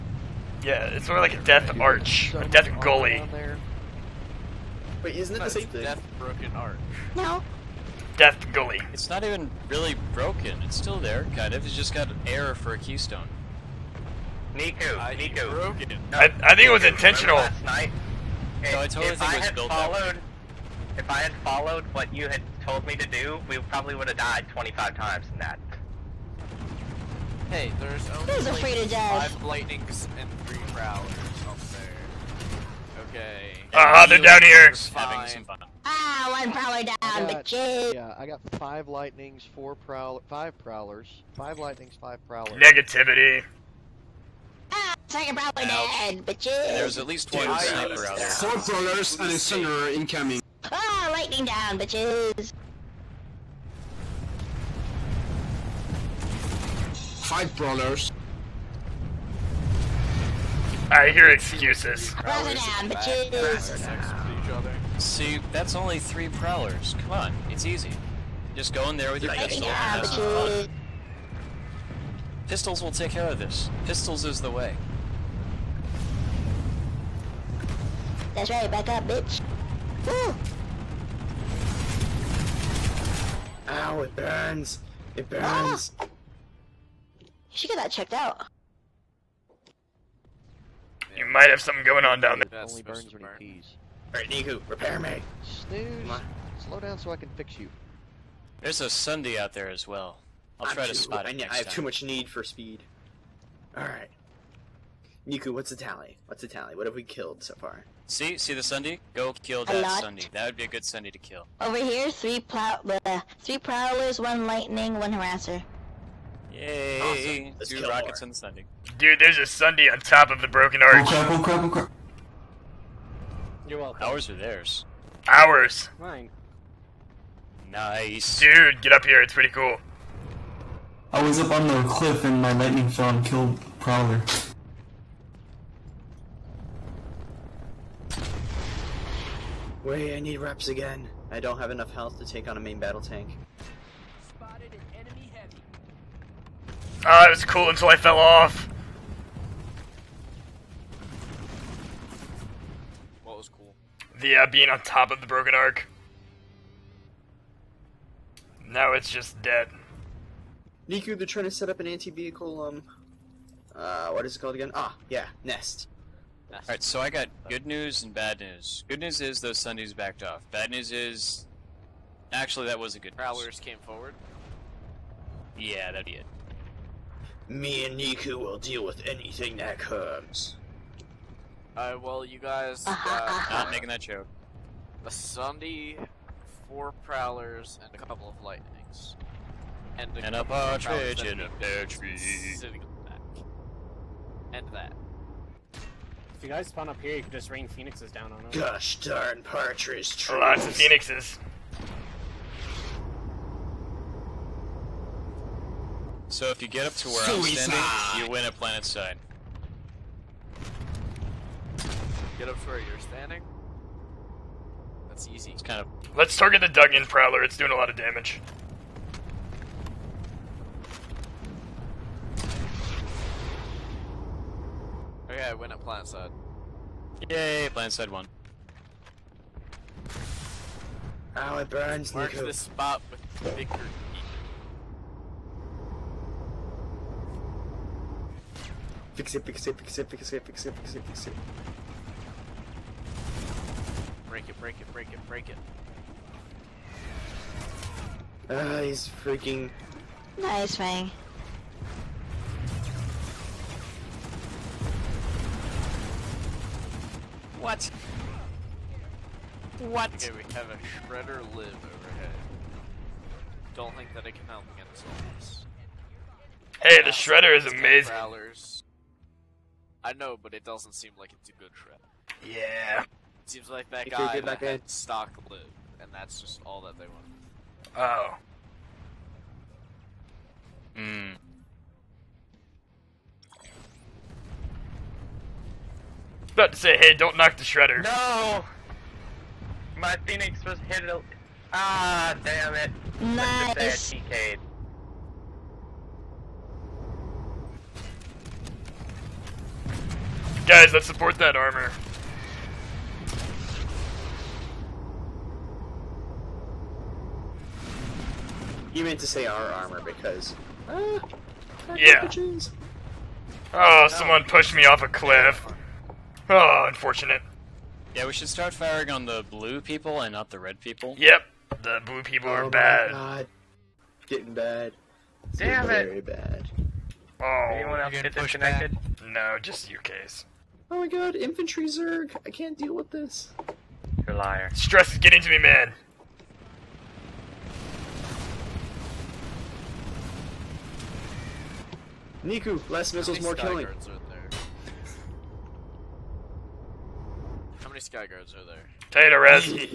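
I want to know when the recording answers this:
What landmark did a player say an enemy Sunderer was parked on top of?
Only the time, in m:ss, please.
1:59.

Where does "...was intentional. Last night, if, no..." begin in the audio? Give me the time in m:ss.
0:16.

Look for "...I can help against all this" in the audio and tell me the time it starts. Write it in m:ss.
4:24.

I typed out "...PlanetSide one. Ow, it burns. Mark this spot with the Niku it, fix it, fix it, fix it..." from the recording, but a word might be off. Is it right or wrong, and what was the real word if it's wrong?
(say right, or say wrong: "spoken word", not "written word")
wrong: "Fix", not "Niku".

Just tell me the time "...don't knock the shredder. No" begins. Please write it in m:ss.
4:47.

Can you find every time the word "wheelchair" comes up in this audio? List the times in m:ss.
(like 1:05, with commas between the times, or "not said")
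not said.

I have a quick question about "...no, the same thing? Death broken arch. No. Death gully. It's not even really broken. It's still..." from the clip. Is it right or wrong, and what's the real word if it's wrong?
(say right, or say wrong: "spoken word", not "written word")
right.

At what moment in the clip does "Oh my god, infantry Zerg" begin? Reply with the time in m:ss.
5:30.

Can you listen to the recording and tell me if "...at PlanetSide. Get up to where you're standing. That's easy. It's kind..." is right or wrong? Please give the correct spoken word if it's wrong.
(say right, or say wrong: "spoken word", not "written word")
right.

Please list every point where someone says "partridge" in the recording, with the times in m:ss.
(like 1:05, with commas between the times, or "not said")
3:10, 3:19.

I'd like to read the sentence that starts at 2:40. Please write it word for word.
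Niku, they're trying to set up an anti-vehicle, um, uh, what is it called again?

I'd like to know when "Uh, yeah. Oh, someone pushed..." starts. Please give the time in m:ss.
5:10.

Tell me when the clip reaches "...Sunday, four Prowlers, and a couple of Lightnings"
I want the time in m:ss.
3:05.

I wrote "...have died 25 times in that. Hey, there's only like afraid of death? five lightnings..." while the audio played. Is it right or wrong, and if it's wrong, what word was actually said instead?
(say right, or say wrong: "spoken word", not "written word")
right.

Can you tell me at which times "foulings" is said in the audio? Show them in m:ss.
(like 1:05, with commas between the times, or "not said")
not said.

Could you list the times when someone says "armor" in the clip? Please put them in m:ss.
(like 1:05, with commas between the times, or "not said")
5:01, 5:09.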